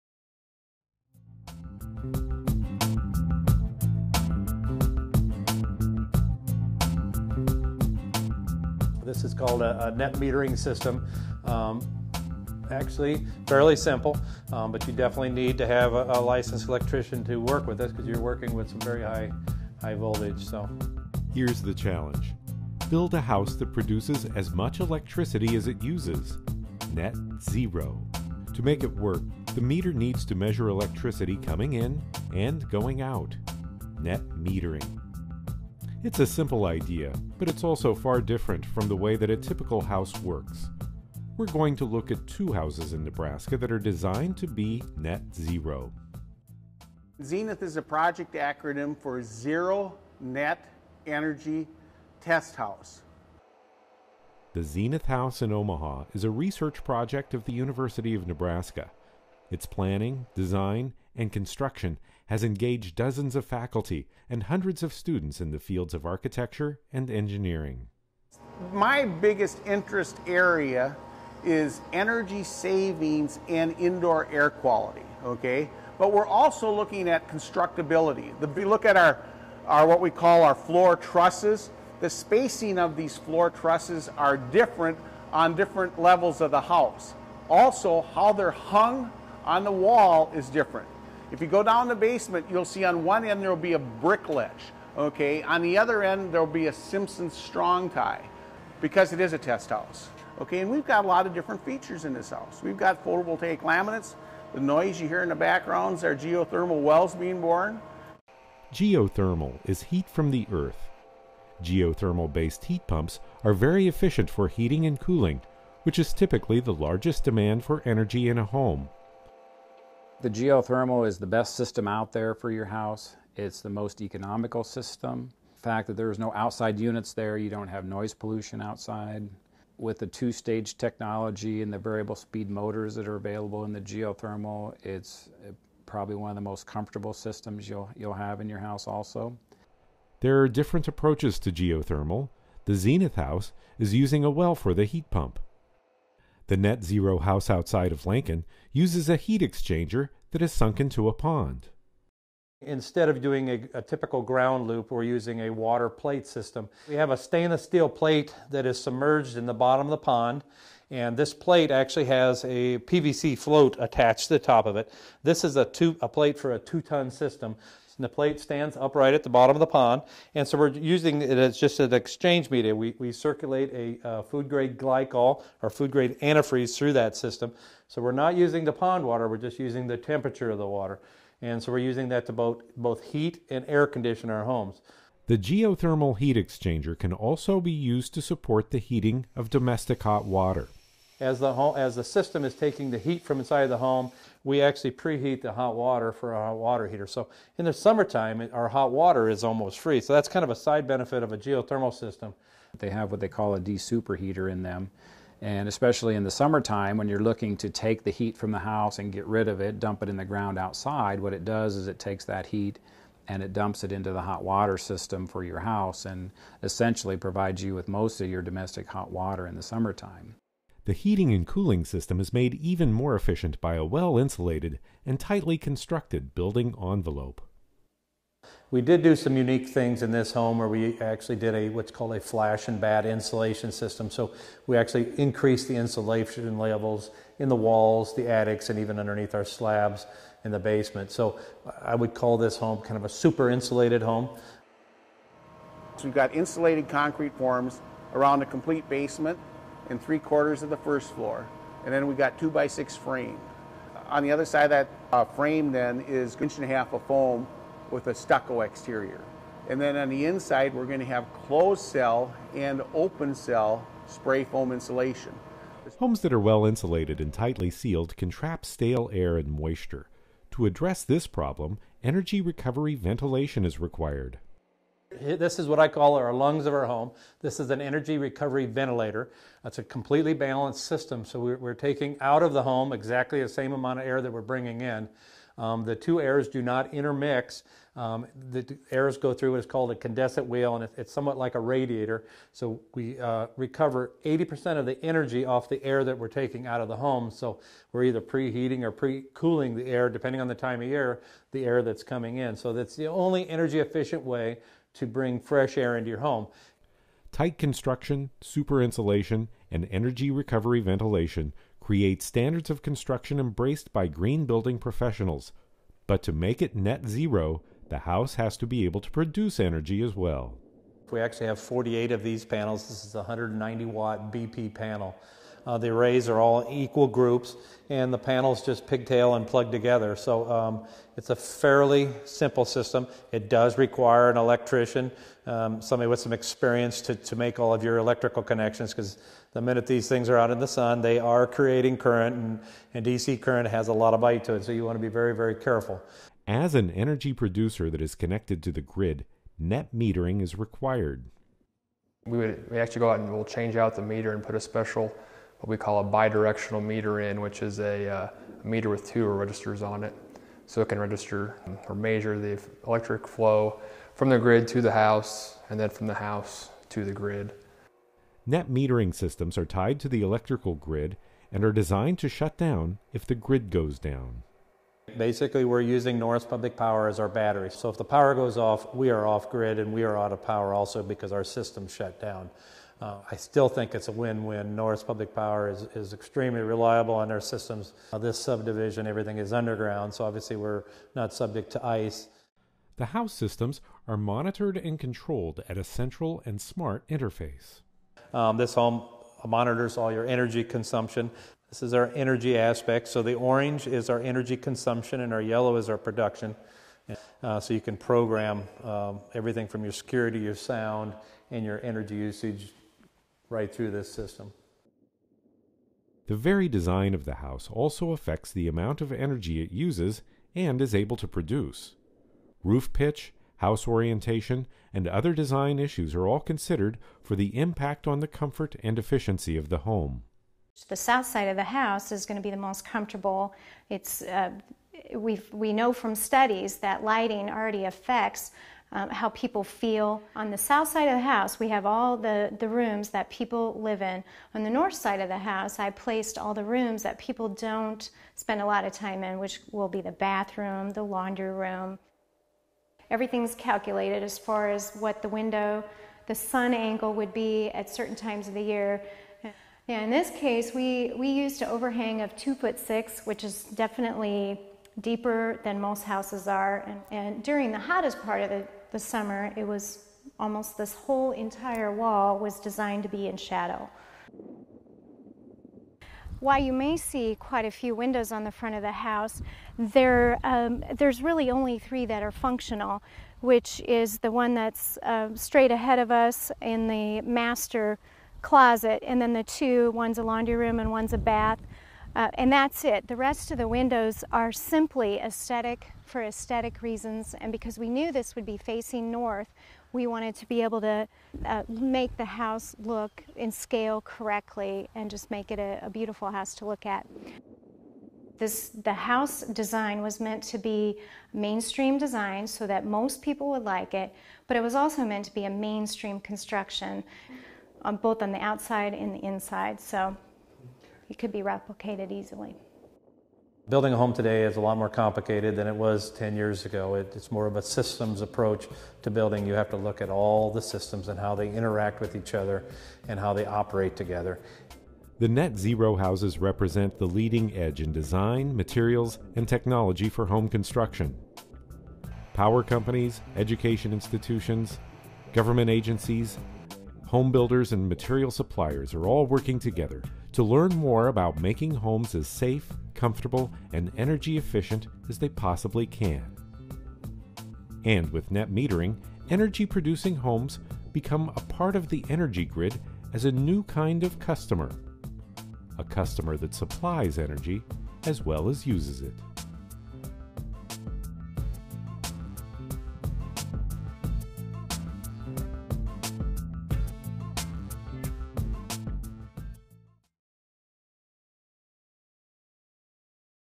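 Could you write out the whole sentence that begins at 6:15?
Basically, we're using Norris Public Power as our battery.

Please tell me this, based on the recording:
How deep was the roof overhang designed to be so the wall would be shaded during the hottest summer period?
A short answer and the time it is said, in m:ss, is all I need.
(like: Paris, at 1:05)
2 feet 6 inches, at 7:42.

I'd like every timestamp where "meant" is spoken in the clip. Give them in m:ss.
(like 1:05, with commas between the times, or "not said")
8:30, 8:35.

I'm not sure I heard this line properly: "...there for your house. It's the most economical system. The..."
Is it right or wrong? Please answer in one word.
right.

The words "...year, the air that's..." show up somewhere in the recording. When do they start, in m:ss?
5:00.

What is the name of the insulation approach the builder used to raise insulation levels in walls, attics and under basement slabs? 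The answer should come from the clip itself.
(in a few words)
Flash and batt.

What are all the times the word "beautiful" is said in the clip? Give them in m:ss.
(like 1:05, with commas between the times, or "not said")
8:25.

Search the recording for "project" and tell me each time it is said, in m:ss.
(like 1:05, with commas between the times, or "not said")
0:47, 0:56.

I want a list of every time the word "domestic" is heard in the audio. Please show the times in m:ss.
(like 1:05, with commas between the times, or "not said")
3:09, 3:38.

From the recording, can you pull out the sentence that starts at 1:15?
But we're also looking at constructability.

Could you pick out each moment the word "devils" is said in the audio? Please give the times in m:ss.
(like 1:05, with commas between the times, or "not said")
not said.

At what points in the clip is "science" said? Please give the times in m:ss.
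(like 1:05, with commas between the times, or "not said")
not said.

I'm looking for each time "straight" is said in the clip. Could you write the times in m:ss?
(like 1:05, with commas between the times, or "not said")
8:05.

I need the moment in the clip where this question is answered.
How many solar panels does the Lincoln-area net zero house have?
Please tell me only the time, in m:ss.
5:21.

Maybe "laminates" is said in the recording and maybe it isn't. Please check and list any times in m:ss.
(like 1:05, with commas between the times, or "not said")
1:43.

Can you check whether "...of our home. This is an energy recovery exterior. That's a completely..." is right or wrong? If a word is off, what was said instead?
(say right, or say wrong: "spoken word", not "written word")
wrong: "ventilator", not "exterior".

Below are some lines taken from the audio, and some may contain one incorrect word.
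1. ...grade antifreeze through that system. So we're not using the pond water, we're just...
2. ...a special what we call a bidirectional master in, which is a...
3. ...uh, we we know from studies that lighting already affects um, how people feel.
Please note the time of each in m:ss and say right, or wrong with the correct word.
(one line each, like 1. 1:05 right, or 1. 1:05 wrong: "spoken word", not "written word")
1. 2:55 right
2. 5:54 wrong: "meter", not "master"
3. 7:14 right.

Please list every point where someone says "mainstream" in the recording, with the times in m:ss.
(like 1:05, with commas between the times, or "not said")
8:31, 8:35.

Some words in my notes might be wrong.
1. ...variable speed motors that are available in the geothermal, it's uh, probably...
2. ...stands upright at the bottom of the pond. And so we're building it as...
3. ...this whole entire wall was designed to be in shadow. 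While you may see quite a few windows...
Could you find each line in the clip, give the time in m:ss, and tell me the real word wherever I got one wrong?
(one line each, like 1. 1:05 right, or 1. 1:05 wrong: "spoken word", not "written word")
1. 2:11 right
2. 2:48 wrong: "using", not "building"
3. 7:50 right.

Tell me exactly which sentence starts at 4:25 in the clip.
Homes that are well insulated and tightly sealed can trap stale air and moisture.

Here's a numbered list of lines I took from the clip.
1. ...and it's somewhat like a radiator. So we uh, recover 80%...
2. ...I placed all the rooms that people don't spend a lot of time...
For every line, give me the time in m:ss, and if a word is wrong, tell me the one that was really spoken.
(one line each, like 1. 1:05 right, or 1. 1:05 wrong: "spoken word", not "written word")
1. 4:50 right
2. 7:25 right.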